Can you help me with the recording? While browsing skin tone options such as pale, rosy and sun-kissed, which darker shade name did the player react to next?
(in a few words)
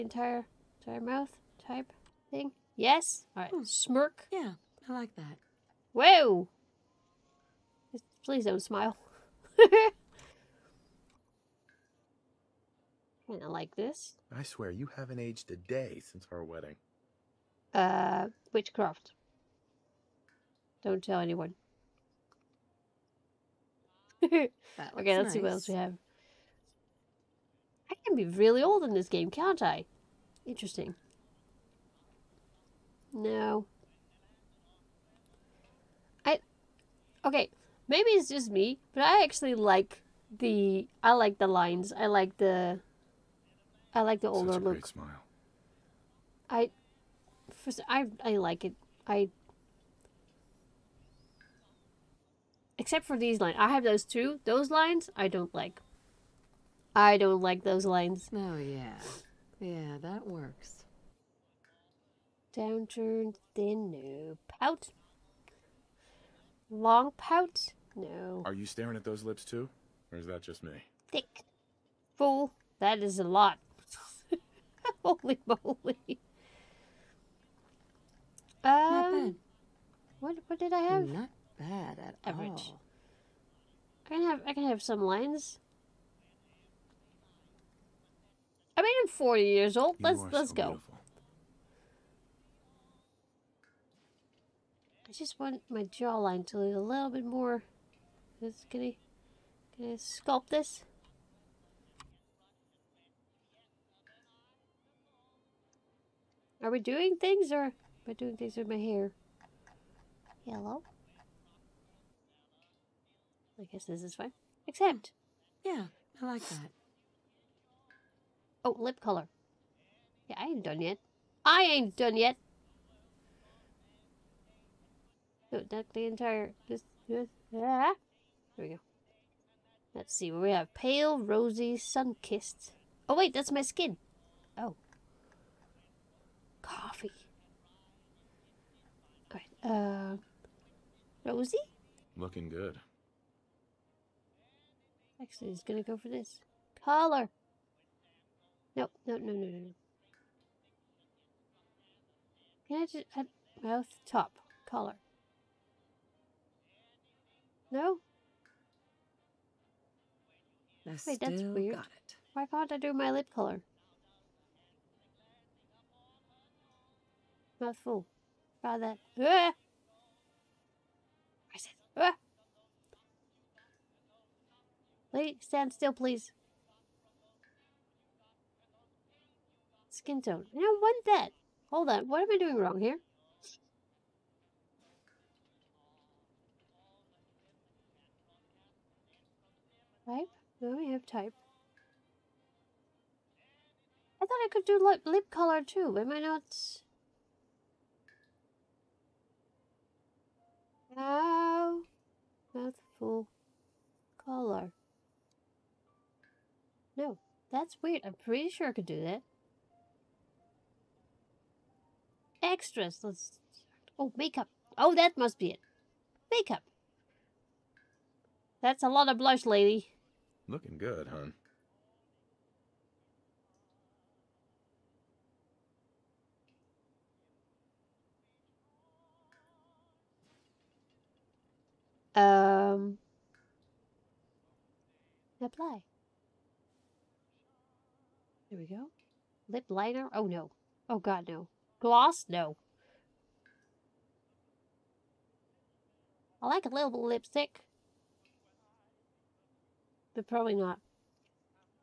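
Coffee.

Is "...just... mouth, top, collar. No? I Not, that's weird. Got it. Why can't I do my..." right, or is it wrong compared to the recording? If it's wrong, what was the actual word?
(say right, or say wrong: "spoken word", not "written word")
wrong: "Wait", not "Not".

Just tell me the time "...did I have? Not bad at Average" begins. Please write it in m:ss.
1:20.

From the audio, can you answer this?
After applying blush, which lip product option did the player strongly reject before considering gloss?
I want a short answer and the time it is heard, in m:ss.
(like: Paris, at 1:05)
Lip liner, at 3:59.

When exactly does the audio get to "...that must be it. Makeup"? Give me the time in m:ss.
3:34.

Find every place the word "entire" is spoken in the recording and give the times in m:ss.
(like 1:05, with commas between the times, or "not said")
0:00, 2:06.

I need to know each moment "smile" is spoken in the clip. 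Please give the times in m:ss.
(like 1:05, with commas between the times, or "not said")
0:08, 0:44.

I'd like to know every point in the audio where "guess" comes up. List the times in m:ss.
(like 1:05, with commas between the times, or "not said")
1:53.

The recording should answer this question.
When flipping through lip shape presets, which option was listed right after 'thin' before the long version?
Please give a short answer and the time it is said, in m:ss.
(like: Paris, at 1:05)
New pout, at 1:03.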